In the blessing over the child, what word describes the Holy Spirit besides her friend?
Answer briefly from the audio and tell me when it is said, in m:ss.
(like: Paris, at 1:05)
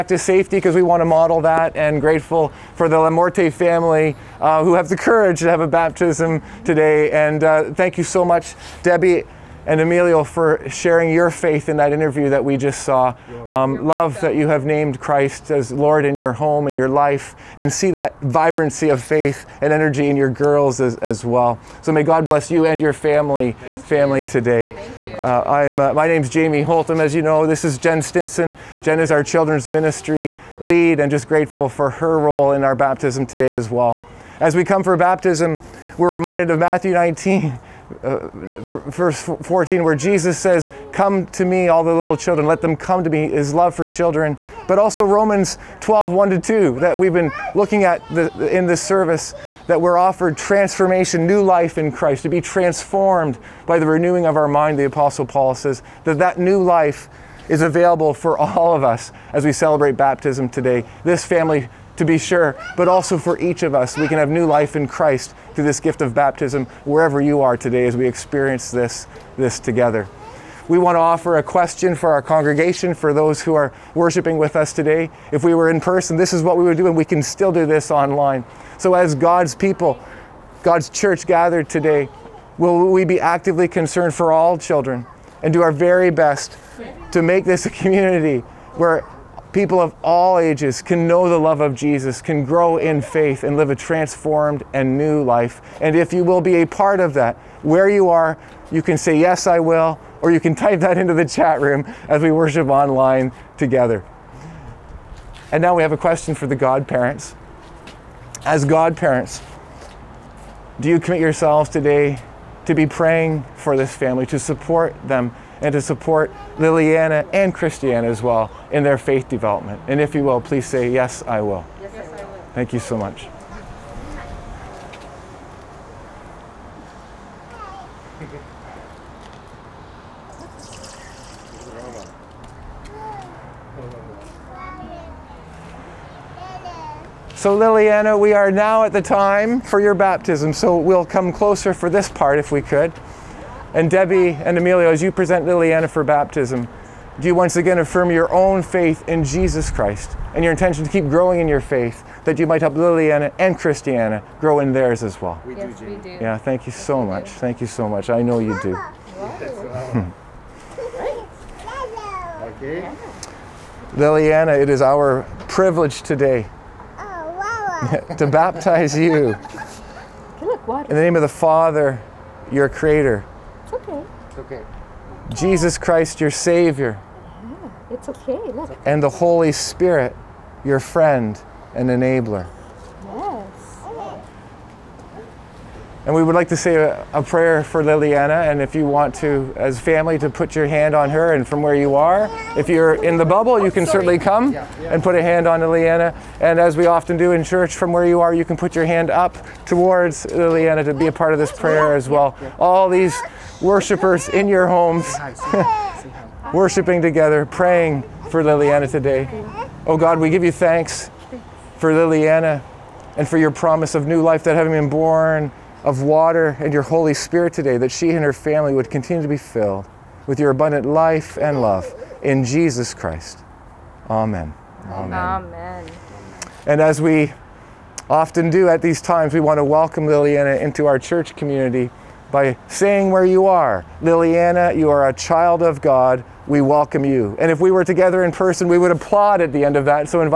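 enabler, at 3:01.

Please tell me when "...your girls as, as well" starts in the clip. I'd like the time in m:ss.
0:20.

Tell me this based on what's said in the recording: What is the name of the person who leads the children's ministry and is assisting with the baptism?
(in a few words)
Jen Stinson.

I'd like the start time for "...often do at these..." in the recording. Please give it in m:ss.
3:48.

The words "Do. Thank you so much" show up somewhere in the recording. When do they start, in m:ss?
2:37.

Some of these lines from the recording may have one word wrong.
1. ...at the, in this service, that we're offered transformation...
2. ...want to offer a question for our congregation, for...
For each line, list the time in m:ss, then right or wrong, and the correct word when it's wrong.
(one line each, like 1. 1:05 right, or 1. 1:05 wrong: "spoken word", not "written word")
1. 0:47 right
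2. 1:10 right.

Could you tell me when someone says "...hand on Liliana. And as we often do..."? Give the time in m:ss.
3:15.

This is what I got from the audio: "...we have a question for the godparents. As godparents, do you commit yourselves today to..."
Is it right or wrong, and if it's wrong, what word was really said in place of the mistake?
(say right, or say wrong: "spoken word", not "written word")
right.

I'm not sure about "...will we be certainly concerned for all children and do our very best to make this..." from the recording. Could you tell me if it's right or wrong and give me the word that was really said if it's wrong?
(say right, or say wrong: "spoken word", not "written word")
wrong: "actively", not "certainly".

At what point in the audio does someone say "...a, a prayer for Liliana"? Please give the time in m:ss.
3:06.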